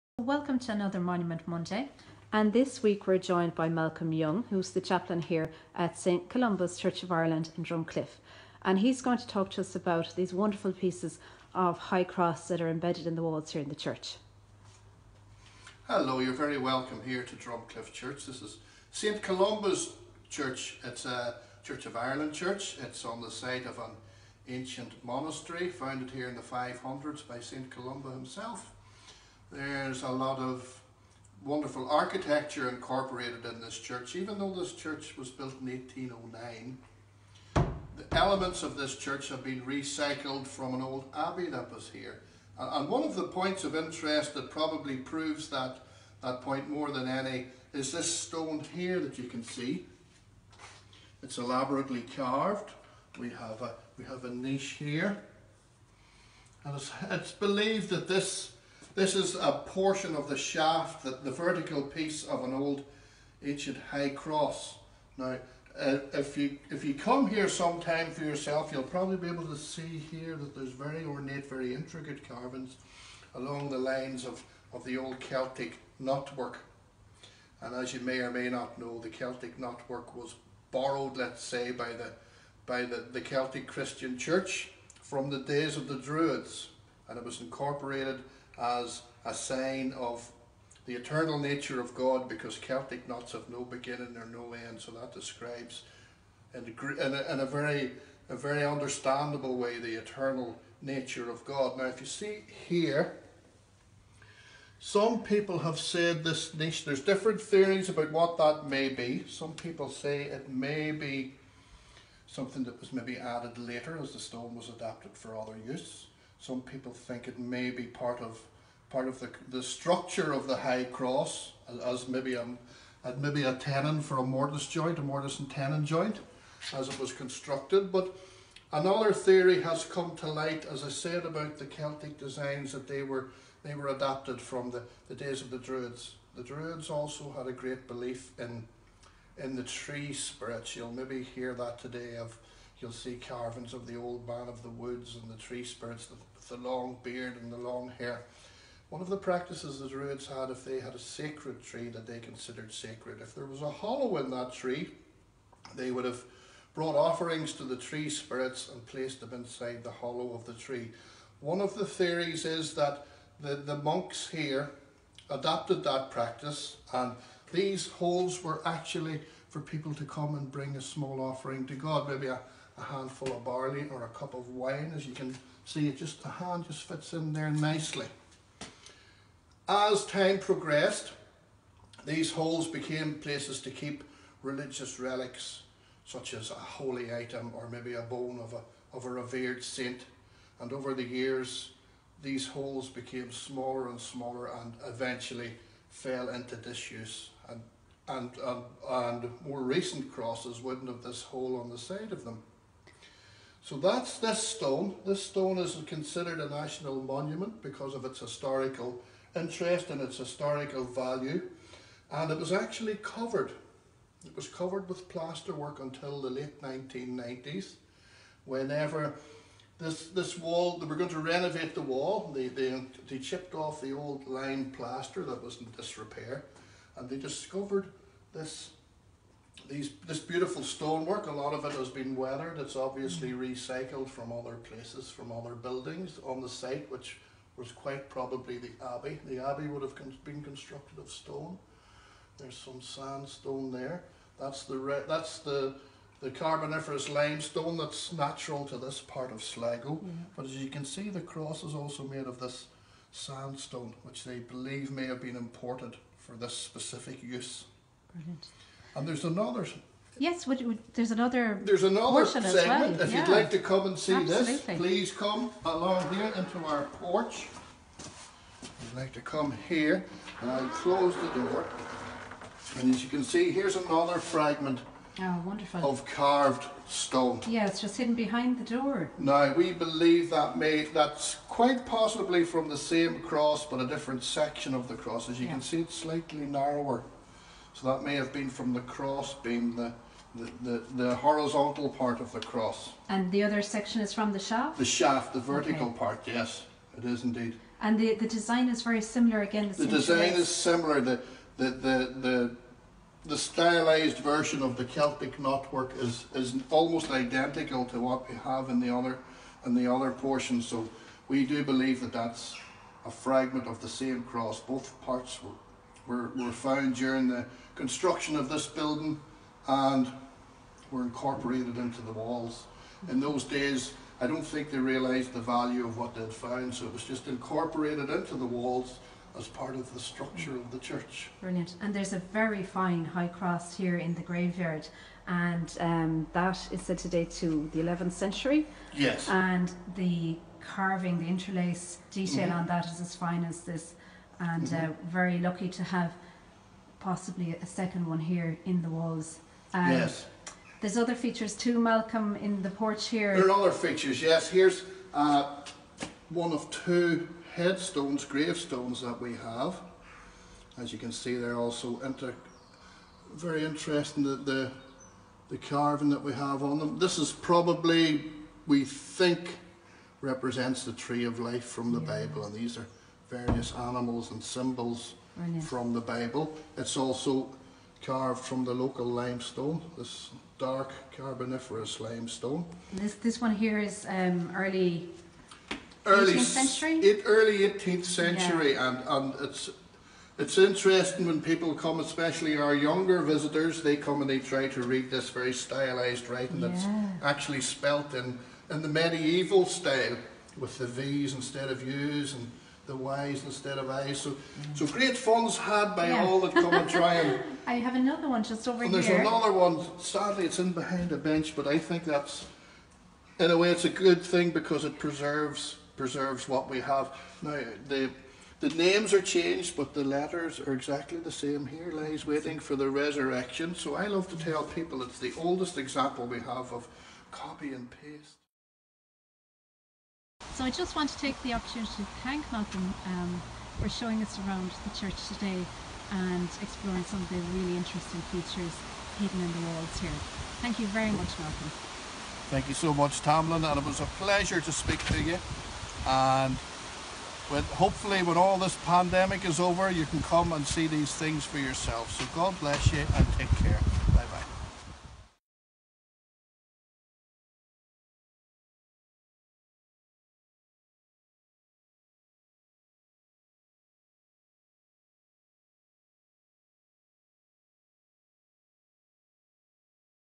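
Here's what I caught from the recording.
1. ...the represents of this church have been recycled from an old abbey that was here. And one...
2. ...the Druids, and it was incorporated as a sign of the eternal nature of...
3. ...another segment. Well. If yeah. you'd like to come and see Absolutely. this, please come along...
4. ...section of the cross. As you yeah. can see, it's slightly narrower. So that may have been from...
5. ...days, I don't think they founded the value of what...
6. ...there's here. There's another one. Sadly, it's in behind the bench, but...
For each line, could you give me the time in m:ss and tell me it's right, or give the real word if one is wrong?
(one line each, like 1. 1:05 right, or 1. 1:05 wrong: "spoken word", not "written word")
1. 0:37 wrong: "elements", not "represents"
2. 1:25 right
3. 4:21 right
4. 4:44 right
5. 5:23 wrong: "realised", not "founded"
6. 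6:48 right.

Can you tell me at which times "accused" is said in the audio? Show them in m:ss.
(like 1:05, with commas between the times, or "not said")
not said.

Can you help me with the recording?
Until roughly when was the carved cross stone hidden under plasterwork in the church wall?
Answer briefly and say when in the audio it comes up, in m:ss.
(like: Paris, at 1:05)
Late 1990s, at 3:36.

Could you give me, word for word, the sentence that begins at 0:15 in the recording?
Hello, you're very welcome here to Drumcliffe Church.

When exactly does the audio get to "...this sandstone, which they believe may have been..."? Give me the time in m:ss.
4:12.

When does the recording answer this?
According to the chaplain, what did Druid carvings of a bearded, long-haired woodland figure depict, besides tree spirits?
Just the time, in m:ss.
2:23.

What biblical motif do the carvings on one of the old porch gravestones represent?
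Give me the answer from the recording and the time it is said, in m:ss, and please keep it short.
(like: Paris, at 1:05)
The tree of life, at 6:10.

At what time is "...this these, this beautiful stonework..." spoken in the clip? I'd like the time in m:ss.
3:48.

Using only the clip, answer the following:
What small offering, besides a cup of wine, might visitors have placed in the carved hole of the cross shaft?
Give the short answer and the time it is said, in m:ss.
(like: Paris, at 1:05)
A handful of barley, at 2:52.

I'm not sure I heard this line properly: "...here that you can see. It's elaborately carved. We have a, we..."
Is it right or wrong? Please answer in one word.
right.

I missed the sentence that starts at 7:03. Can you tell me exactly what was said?
So I love to tell people it's the oldest example we have of copy and paste.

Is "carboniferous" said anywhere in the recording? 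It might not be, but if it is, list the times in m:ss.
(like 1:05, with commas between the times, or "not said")
4:06, 6:21.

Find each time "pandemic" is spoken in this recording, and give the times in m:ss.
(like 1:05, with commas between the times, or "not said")
7:28.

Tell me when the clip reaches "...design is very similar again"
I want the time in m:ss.
4:58.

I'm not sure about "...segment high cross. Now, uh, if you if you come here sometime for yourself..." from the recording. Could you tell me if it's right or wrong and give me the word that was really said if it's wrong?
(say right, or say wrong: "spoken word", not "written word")
wrong: "ancient", not "segment".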